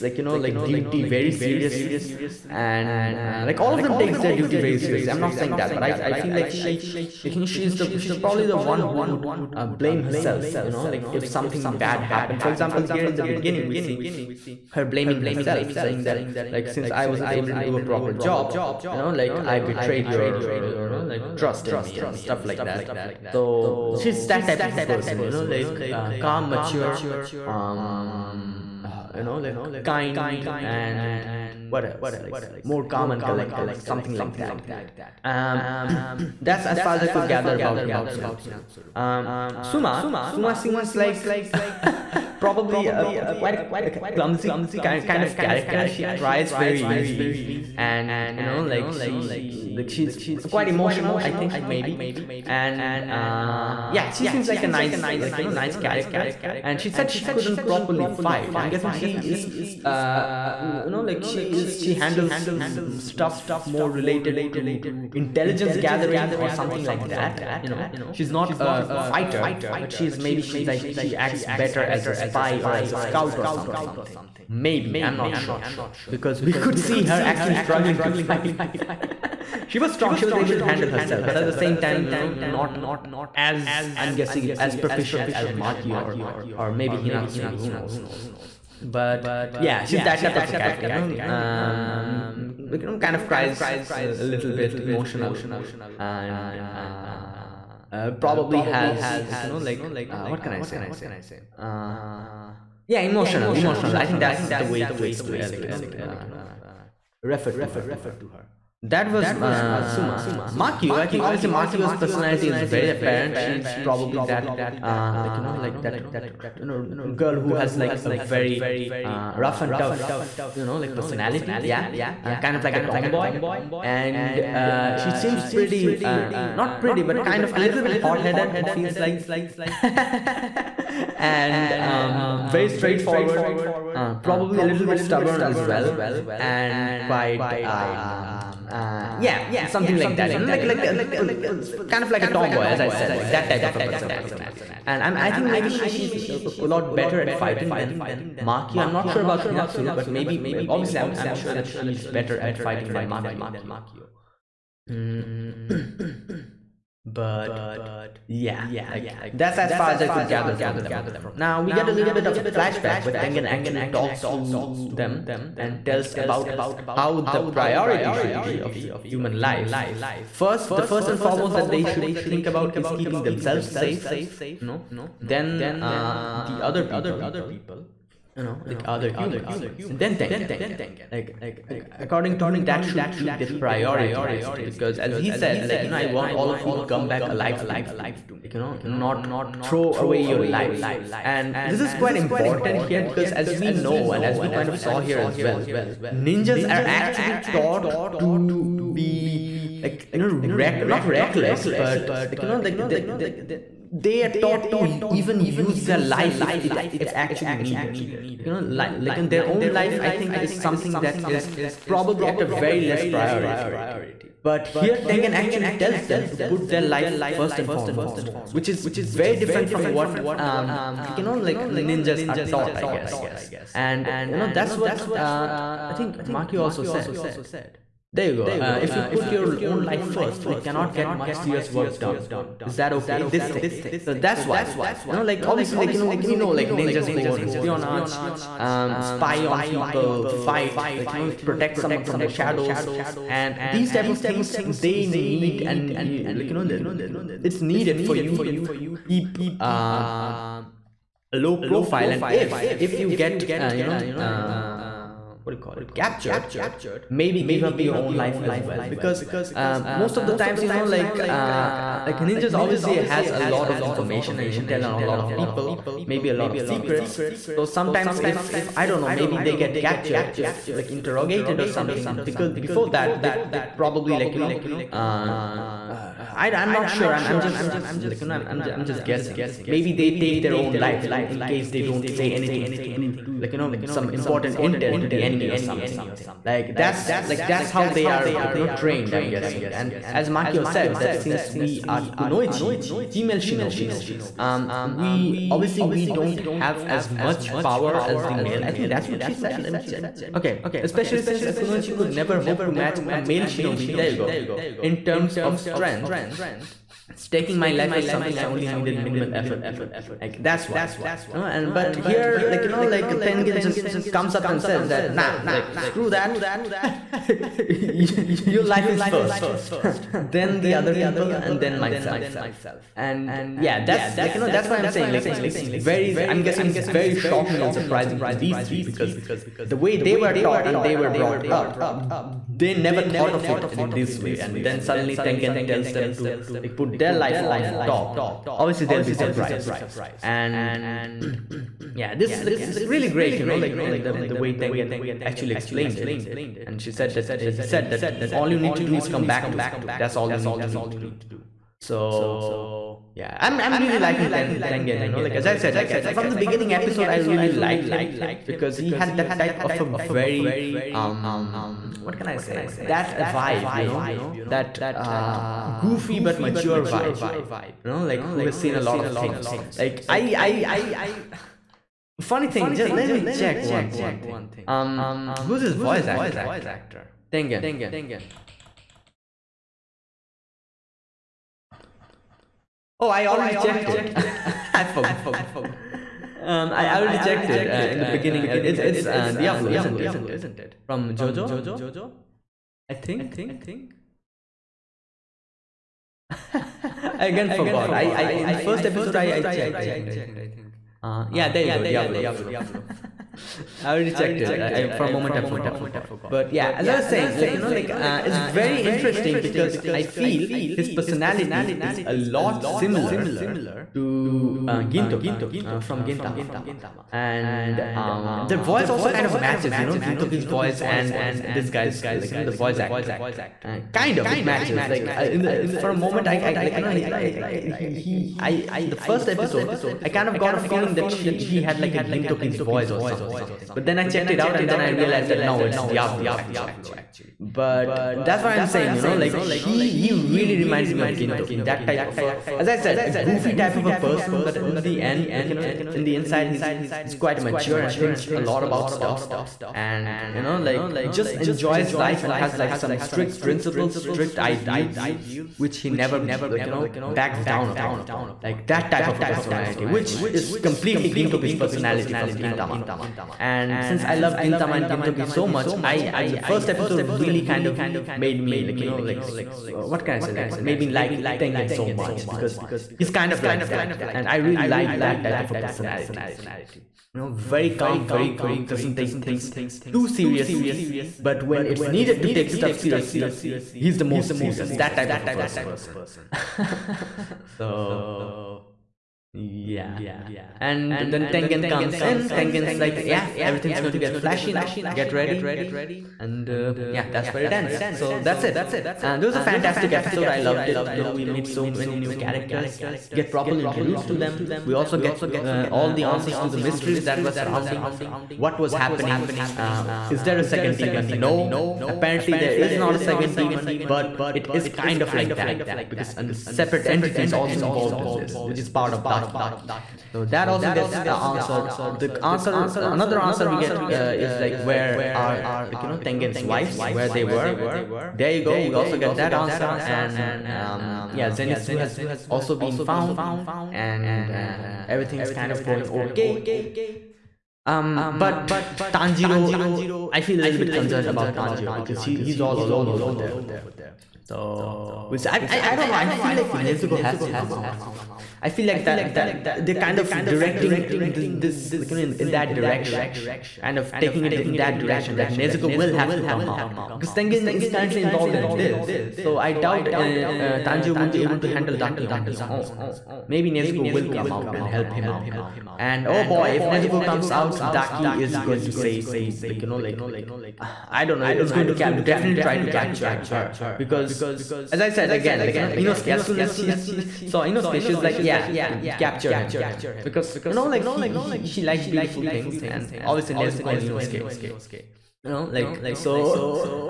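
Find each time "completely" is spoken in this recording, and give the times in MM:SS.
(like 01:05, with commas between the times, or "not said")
07:40.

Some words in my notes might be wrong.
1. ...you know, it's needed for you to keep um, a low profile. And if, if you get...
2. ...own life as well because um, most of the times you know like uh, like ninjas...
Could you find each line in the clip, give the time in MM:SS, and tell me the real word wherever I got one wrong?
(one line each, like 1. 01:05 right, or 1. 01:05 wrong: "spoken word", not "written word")
1. 04:06 right
2. 04:18 right.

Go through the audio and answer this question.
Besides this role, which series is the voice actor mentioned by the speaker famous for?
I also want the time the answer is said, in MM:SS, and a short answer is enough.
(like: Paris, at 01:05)
Jojo, at 06:31.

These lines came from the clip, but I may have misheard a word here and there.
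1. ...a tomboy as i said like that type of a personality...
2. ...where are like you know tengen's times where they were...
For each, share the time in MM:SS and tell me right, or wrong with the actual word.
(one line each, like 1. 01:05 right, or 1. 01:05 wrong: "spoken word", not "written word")
1. 02:22 right
2. 08:44 wrong: "wives", not "times".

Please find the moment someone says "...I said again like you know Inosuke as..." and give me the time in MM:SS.
09:34.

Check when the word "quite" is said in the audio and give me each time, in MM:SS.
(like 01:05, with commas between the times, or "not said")
00:43, 00:50, 02:17, 03:11, 07:27.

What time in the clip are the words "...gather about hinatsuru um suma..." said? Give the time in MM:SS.
00:37.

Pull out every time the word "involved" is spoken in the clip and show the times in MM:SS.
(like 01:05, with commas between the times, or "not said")
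08:37, 09:18.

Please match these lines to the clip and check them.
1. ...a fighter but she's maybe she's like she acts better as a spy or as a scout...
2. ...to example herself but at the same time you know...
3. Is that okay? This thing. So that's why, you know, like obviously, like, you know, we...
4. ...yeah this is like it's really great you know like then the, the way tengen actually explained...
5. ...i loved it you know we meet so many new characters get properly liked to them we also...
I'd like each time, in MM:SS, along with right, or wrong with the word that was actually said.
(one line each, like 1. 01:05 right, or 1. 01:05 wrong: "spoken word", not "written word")
1. 01:08 right
2. 01:20 wrong: "handle", not "example"
3. 03:52 right
4. 05:41 right
5. 08:20 wrong: "introduced", not "liked".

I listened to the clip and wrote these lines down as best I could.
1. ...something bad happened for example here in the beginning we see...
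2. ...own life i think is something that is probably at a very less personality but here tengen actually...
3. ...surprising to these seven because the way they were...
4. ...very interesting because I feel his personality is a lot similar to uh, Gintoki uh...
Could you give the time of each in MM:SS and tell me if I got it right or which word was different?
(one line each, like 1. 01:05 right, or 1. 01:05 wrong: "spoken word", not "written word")
1. 00:11 right
2. 03:29 wrong: "priority", not "personality"
3. 05:27 wrong: "three", not "seven"
4. 06:48 right.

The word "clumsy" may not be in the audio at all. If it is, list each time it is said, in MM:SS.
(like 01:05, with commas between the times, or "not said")
00:44.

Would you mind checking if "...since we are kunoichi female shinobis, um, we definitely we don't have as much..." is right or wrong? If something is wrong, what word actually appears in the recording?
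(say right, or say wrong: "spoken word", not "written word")
wrong: "obviously", not "definitely".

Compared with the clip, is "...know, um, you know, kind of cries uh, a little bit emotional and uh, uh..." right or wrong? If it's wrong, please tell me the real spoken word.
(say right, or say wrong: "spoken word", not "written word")
right.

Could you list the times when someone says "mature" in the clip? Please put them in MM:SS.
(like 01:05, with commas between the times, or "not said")
00:26, 06:06, 07:27.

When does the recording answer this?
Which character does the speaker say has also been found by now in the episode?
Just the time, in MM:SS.
08:51.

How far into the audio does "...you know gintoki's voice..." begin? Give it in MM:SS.
06:59.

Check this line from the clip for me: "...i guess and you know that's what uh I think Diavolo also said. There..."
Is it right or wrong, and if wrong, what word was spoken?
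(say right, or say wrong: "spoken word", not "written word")
wrong: "Makio", not "Diavolo".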